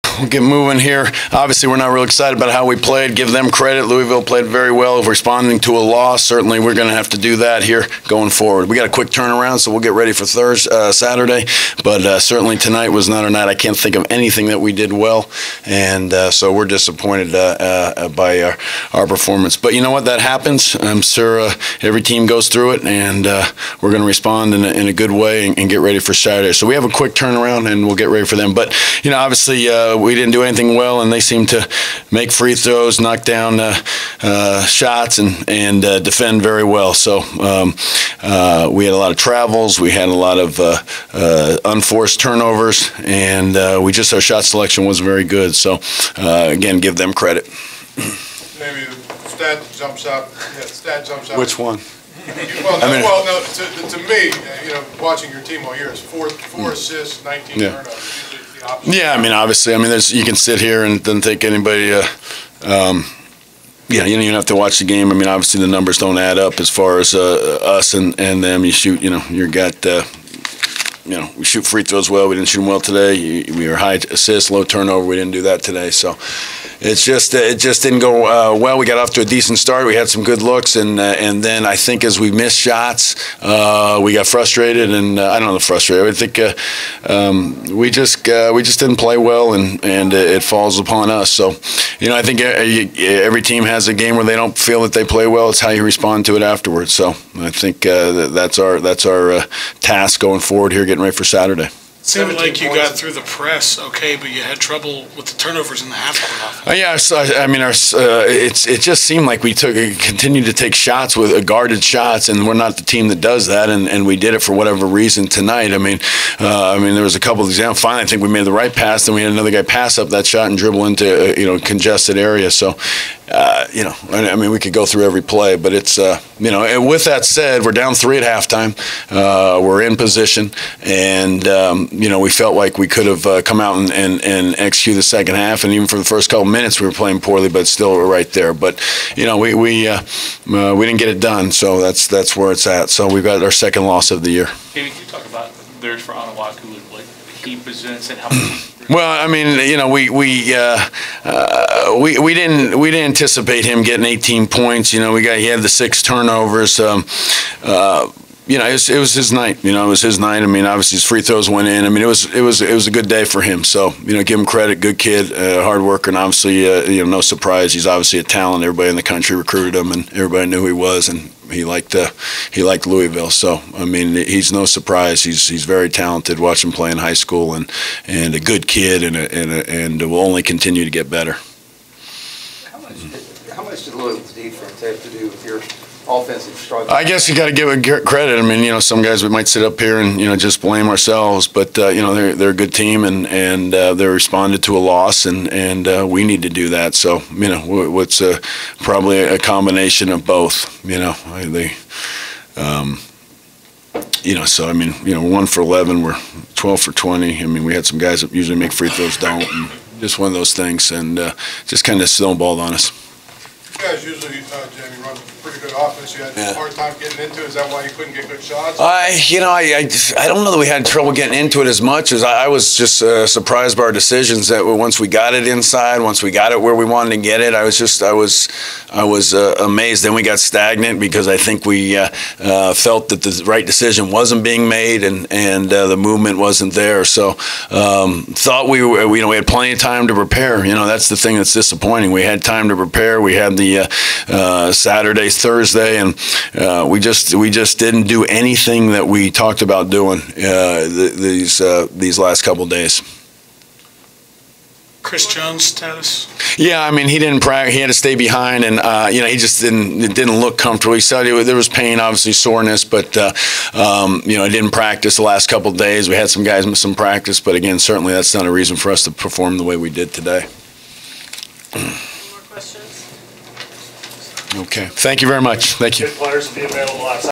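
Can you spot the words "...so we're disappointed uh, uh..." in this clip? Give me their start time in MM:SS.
00:16.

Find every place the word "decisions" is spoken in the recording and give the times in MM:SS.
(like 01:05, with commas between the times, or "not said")
03:43, 03:53.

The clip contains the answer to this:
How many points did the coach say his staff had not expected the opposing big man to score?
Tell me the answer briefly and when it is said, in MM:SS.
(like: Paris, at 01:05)
18, at 02:34.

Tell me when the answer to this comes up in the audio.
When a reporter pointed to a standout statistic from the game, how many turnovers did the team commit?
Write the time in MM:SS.
00:57.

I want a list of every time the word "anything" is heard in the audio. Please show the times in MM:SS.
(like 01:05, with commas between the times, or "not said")
00:14, 00:30, 04:08.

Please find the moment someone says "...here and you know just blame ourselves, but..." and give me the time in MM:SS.
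03:09.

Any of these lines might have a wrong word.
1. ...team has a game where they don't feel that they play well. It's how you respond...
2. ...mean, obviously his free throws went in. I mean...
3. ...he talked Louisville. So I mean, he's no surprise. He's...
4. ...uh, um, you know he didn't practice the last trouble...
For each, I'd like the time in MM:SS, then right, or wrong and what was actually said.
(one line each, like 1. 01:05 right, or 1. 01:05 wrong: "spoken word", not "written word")
1. 01:33 right
2. 02:40 right
3. 02:52 wrong: "liked", not "talked"
4. 04:23 wrong: "couple", not "trouble".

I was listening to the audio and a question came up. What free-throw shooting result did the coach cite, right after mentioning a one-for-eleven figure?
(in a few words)
12 for 20.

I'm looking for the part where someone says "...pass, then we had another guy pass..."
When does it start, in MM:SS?
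01:58.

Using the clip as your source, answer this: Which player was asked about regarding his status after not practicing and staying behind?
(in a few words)
Chris Jones.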